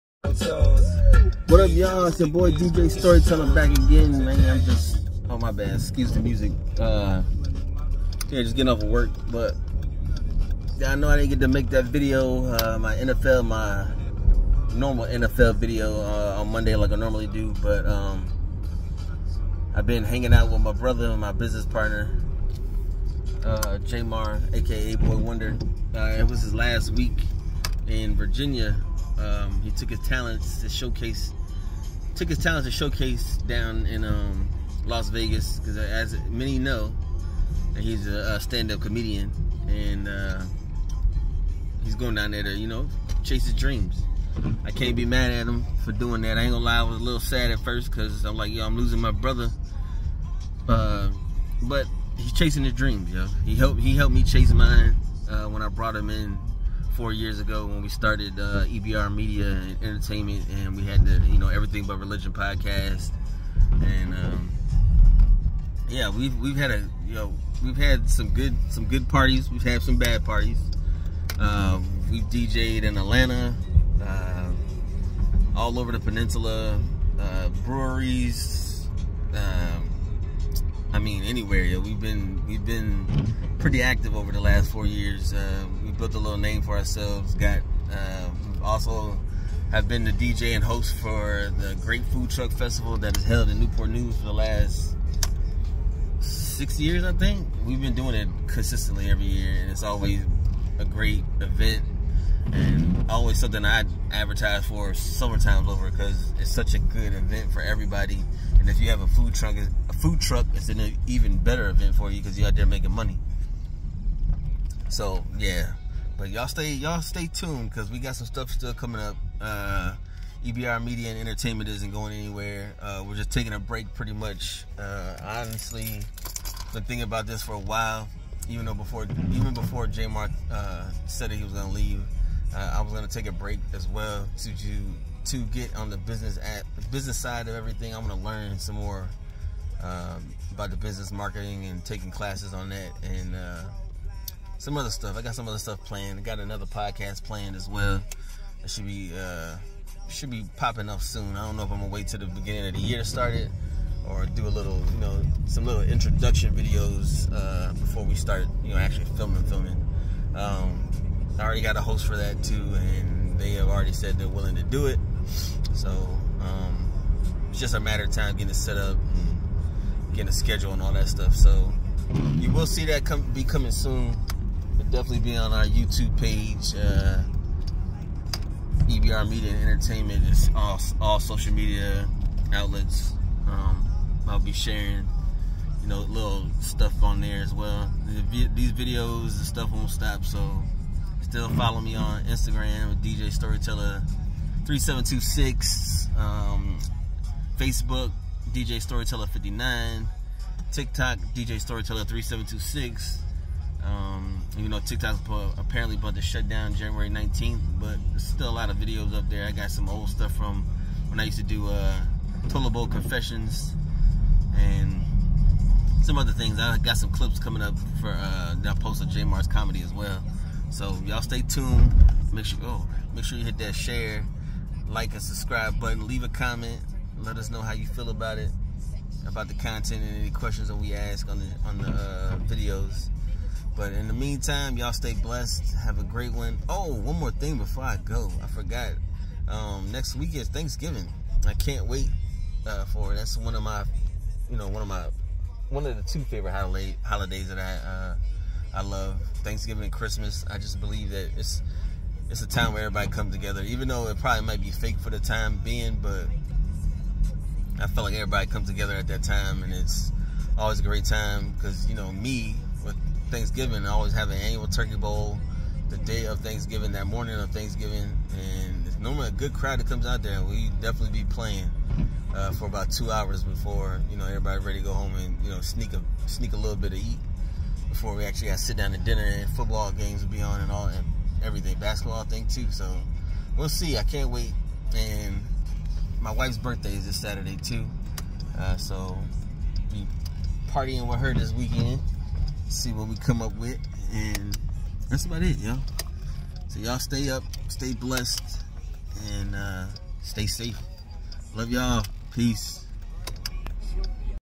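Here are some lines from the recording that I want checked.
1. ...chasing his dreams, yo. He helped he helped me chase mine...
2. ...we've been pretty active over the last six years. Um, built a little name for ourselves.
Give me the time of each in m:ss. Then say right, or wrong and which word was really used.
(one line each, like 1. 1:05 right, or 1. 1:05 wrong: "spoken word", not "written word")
1. 0:52 right
2. 1:22 wrong: "four", not "six".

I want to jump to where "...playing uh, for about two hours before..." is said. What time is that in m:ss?
4:31.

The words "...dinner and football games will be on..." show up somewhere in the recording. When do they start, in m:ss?
4:38.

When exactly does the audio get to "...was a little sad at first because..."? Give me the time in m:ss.
0:46.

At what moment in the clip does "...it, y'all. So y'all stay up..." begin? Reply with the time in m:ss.
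4:55.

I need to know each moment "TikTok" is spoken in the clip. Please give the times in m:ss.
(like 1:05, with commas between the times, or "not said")
3:20, 3:24.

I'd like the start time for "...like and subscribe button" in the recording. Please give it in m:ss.
3:44.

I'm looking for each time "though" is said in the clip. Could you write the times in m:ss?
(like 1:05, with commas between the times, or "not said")
2:08, 4:13.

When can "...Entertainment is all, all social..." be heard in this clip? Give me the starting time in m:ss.
2:59.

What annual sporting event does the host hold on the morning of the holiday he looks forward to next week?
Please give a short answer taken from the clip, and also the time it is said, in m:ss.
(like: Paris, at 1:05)
turkey bowl, at 4:24.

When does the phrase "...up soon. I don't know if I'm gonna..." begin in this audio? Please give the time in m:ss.
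2:30.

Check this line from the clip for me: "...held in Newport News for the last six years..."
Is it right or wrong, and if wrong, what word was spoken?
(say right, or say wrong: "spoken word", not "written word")
right.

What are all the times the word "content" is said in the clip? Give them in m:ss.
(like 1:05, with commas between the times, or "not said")
3:49.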